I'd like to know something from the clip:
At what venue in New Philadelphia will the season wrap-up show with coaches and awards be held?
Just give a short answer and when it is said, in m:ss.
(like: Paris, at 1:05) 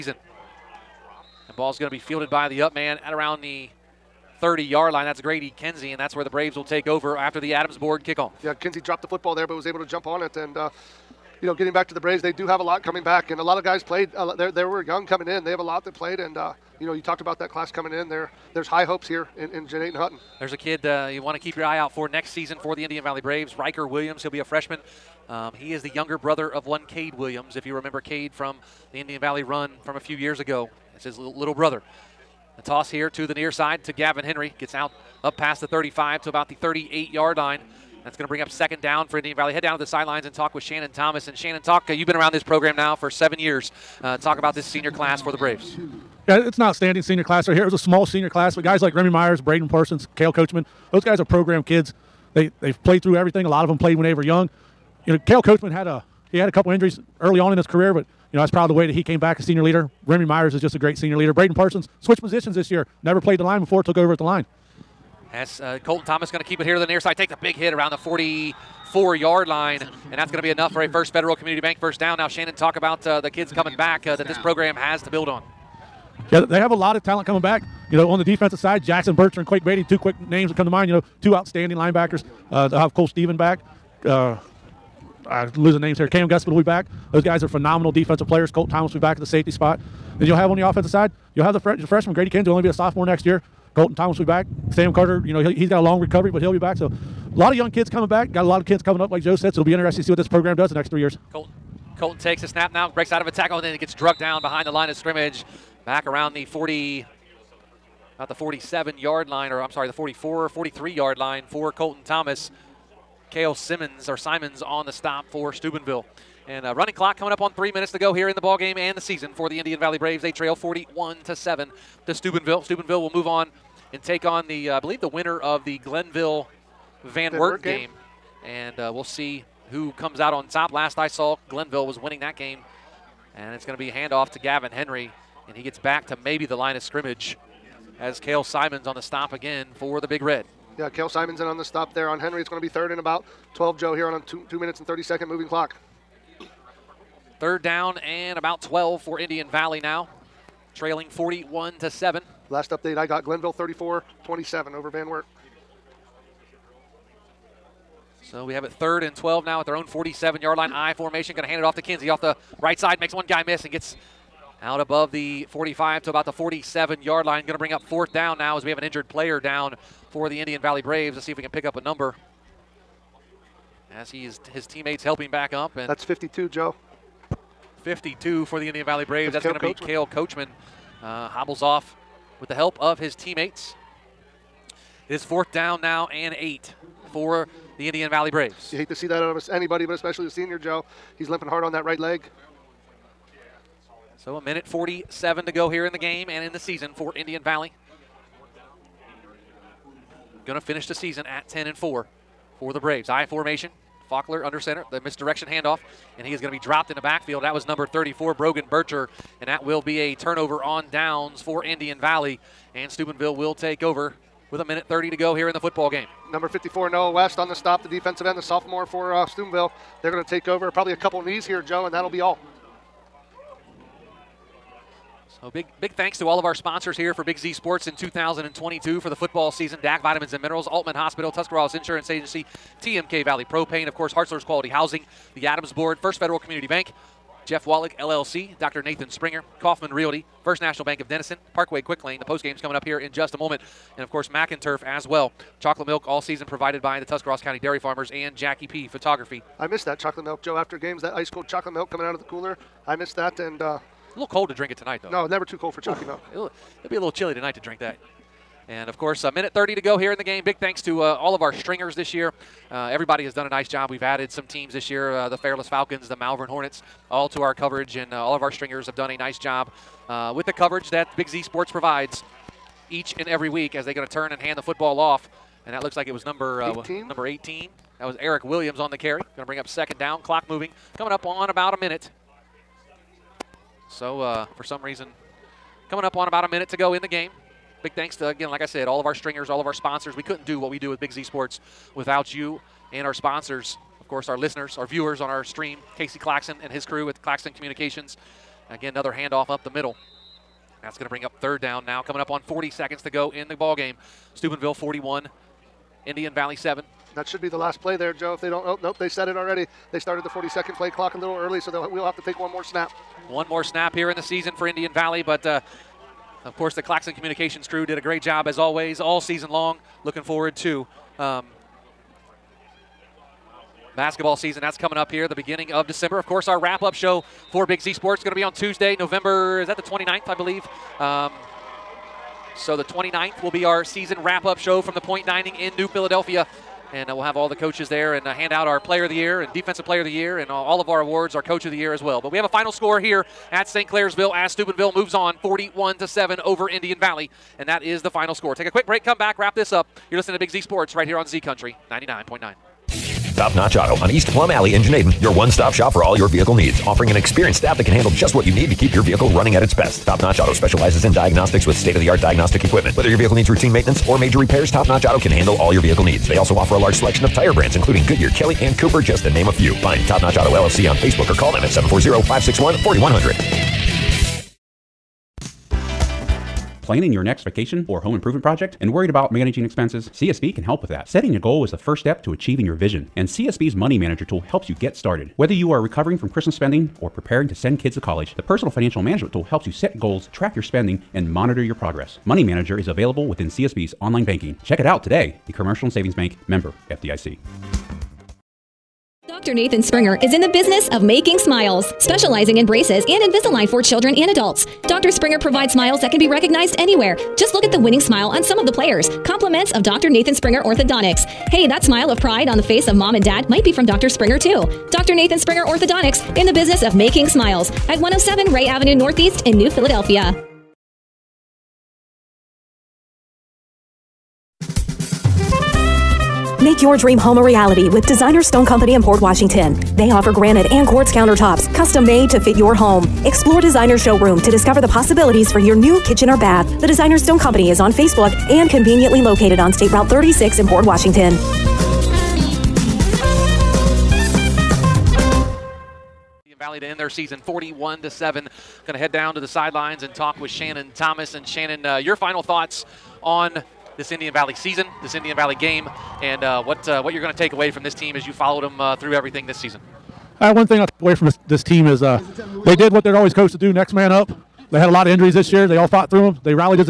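the Point Dining, at 5:34.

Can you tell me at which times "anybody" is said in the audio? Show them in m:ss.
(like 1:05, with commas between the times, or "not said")
3:09.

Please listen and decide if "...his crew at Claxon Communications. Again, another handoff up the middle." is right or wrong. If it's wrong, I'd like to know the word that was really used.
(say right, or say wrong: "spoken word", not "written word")
right.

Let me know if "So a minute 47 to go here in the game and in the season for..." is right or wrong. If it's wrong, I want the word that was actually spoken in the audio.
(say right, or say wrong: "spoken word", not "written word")
right.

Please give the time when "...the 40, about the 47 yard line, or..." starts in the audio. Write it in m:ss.
1:46.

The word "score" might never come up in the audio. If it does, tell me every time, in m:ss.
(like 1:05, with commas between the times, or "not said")
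5:42, 5:48.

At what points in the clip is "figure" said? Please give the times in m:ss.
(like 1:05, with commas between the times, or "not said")
not said.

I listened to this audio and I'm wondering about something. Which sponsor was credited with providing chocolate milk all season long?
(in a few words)
Tuscarawas County Dairy Farmers.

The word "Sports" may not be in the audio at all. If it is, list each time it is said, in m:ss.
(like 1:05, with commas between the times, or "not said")
3:47, 4:31, 4:51, 5:27, 5:50.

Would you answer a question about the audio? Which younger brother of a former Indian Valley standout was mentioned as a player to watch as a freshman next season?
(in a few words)
Riker Williams.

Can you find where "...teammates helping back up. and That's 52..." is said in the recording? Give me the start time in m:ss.
2:54.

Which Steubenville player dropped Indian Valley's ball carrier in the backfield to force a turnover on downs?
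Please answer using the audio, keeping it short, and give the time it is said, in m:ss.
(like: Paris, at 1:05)
Brogan Bircher, at 3:28.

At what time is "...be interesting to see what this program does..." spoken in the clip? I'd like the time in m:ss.
1:39.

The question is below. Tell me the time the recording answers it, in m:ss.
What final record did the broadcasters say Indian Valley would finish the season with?
3:21.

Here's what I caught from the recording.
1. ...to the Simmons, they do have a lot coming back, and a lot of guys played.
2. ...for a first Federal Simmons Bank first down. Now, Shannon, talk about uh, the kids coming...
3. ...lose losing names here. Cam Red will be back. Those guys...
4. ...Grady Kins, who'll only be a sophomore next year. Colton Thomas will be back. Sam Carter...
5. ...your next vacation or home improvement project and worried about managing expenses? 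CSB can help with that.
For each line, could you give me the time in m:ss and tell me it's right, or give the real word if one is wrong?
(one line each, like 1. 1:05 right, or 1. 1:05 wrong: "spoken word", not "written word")
1. 0:11 wrong: "Braves", not "Simmons"
2. 1:10 wrong: "Community", not "Simmons"
3. 1:25 wrong: "Gusman", not "Red"
4. 1:32 right
5. 6:17 right.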